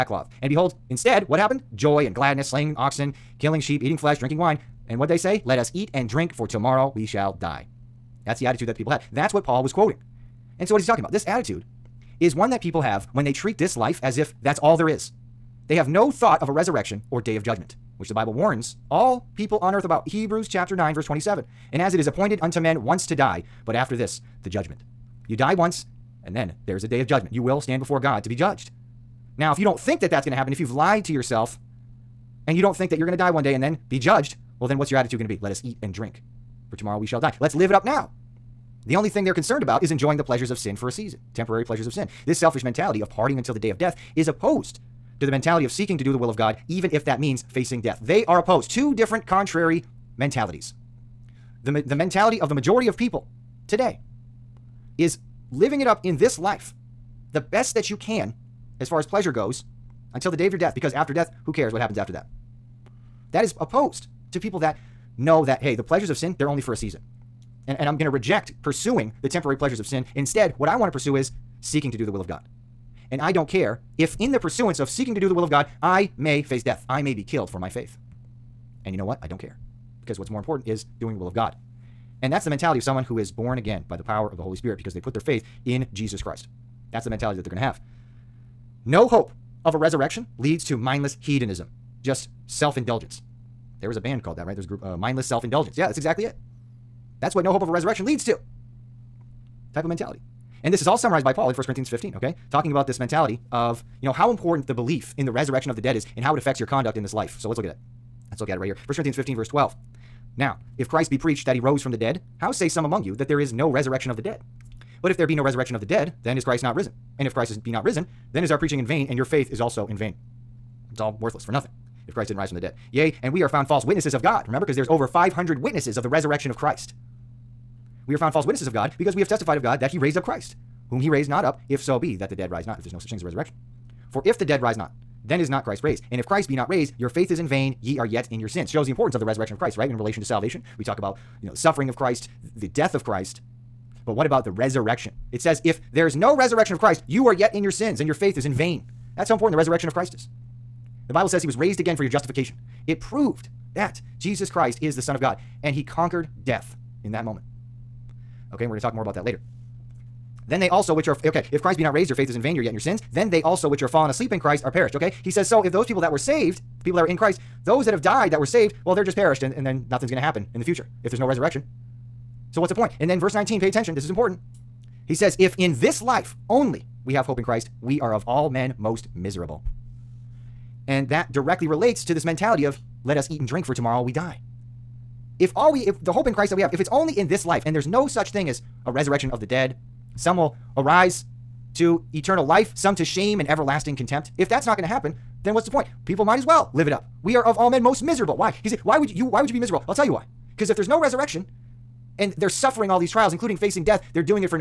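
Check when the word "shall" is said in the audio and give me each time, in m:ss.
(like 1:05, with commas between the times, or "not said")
0:07, 0:37.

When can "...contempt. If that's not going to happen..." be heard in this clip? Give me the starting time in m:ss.
3:13.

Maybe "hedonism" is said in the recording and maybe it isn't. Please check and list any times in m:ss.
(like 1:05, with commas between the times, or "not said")
1:31.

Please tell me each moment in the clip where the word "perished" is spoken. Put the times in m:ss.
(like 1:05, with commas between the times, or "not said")
2:44, 2:49.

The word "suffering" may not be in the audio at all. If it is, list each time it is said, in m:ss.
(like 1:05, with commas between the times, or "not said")
2:21, 3:22.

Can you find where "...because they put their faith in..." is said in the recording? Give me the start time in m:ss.
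1:24.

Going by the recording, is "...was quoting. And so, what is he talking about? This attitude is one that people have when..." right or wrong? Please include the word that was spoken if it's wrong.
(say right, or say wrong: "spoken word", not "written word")
right.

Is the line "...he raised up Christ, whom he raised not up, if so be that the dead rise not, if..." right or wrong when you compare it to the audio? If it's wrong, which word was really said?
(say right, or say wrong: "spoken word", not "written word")
right.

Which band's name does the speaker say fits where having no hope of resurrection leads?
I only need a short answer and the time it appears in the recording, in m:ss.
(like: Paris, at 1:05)
Mindless Self Indulgence, at 1:34.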